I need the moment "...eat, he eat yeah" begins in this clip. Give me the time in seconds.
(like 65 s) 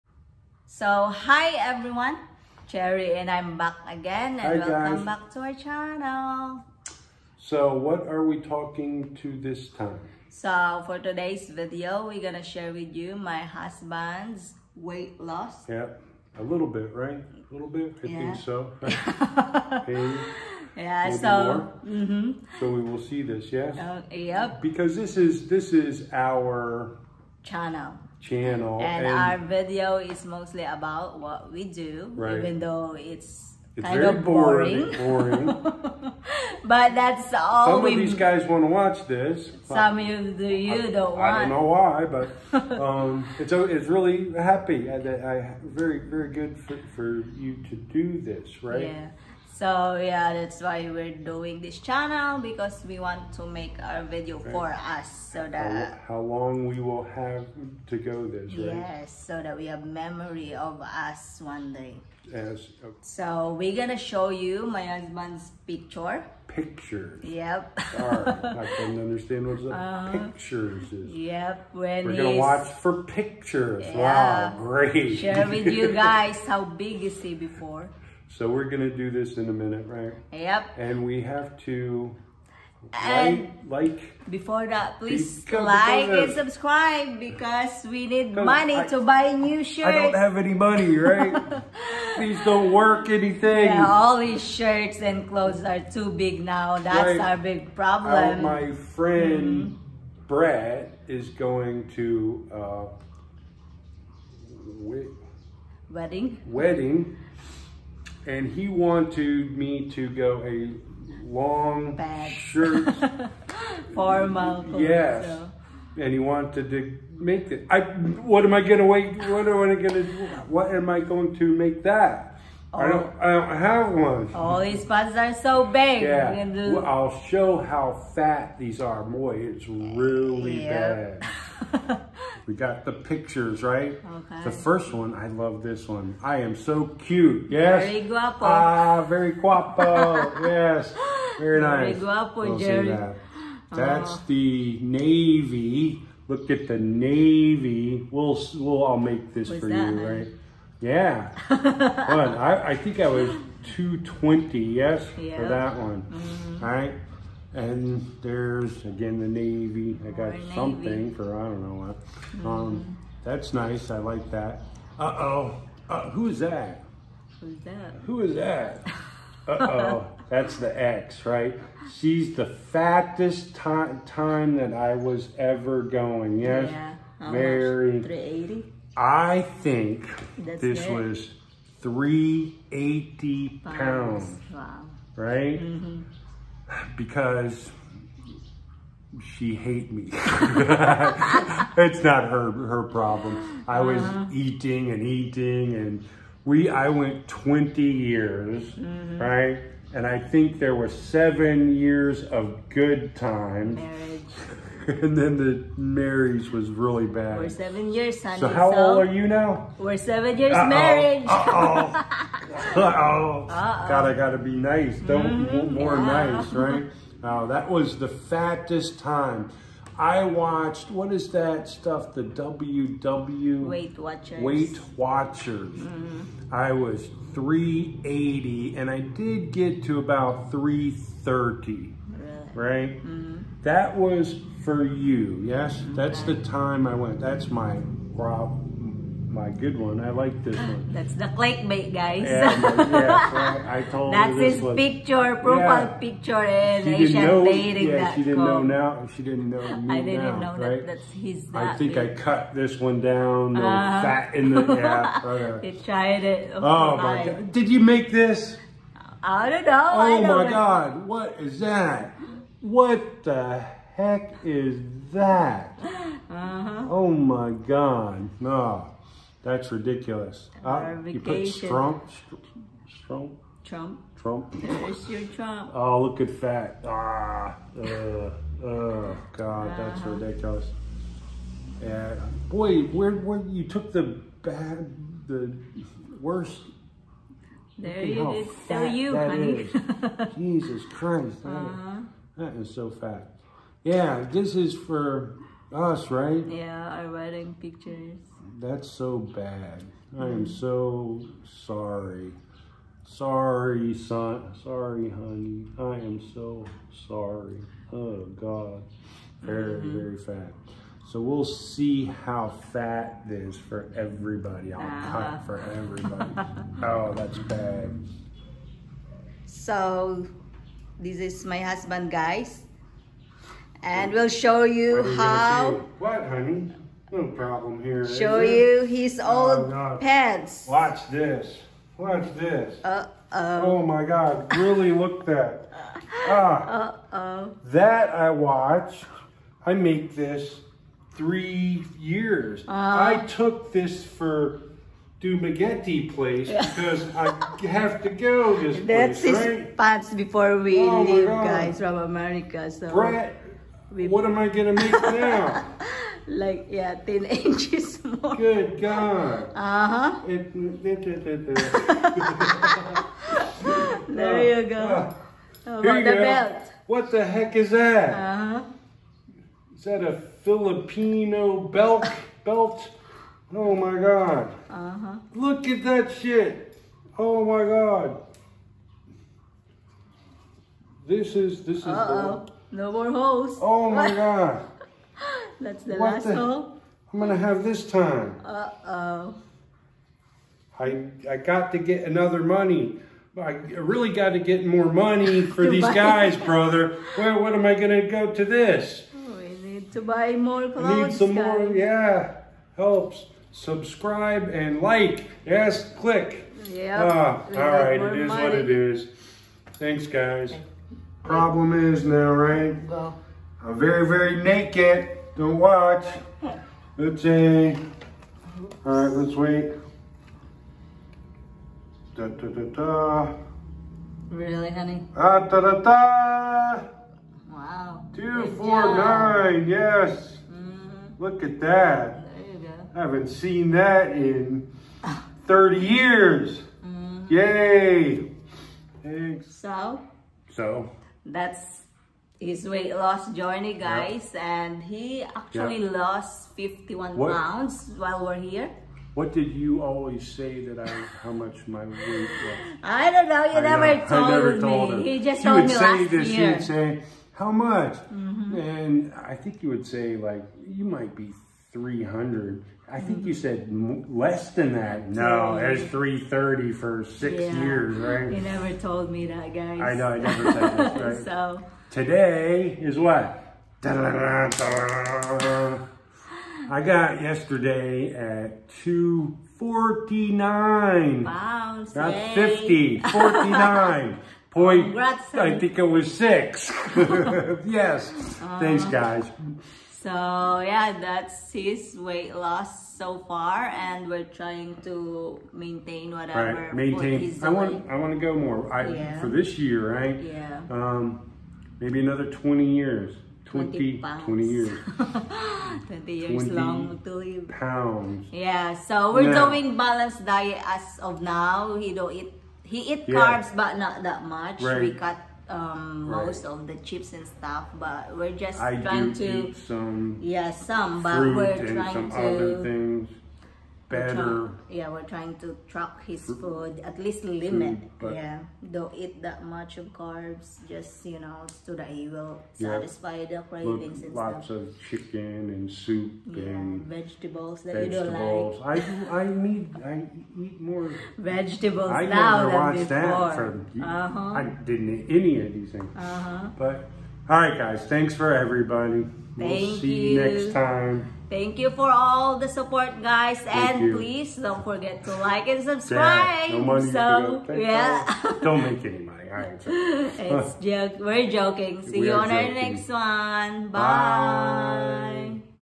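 512 s.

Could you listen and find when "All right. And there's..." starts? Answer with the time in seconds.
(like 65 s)
156 s.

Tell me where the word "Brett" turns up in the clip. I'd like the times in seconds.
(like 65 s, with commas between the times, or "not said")
352 s.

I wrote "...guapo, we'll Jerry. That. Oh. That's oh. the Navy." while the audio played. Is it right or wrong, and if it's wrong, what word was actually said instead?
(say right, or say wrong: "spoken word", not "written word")
right.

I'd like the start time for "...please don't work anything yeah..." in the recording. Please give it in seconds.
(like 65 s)
92 s.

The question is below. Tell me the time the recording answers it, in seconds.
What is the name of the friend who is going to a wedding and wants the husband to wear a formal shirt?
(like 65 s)
100 s.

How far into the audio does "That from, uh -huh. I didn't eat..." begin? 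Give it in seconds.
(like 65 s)
542 s.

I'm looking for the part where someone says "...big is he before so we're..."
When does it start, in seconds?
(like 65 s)
76 s.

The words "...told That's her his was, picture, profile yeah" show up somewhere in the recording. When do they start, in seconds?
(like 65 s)
243 s.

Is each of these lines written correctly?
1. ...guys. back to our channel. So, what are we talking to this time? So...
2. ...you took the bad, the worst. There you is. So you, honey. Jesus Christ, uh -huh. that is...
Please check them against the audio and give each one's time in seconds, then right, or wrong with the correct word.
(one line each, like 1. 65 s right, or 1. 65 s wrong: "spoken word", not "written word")
1. 4 s right
2. 283 s right.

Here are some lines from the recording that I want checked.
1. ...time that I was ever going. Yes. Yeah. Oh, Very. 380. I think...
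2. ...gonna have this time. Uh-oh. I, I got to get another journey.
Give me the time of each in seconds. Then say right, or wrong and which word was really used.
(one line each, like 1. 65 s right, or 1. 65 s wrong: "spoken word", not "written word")
1. 174 s right
2. 387 s wrong: "money", not "journey".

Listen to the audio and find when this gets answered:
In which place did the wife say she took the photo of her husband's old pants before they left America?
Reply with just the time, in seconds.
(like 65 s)
345 s.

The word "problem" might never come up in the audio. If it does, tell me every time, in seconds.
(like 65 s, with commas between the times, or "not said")
97 s, 192 s, 238 s, 327 s, 411 s.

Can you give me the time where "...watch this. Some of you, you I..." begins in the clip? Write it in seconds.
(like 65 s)
38 s.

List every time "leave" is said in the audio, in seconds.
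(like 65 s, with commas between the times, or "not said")
351 s.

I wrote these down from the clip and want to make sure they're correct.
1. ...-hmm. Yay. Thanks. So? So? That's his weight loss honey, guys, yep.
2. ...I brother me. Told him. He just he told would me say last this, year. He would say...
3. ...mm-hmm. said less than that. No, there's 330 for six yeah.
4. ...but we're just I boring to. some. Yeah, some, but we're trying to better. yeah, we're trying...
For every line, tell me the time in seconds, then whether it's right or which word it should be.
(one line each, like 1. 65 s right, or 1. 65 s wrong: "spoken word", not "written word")
1. 436 s wrong: "journey", not "honey"
2. 454 s wrong: "never", not "brother"
3. 463 s right
4. 517 s wrong: "trying", not "boring".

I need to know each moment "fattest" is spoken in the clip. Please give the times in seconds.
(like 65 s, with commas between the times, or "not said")
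172 s, 218 s.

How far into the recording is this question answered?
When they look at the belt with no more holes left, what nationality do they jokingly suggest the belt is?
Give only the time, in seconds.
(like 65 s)
370 s.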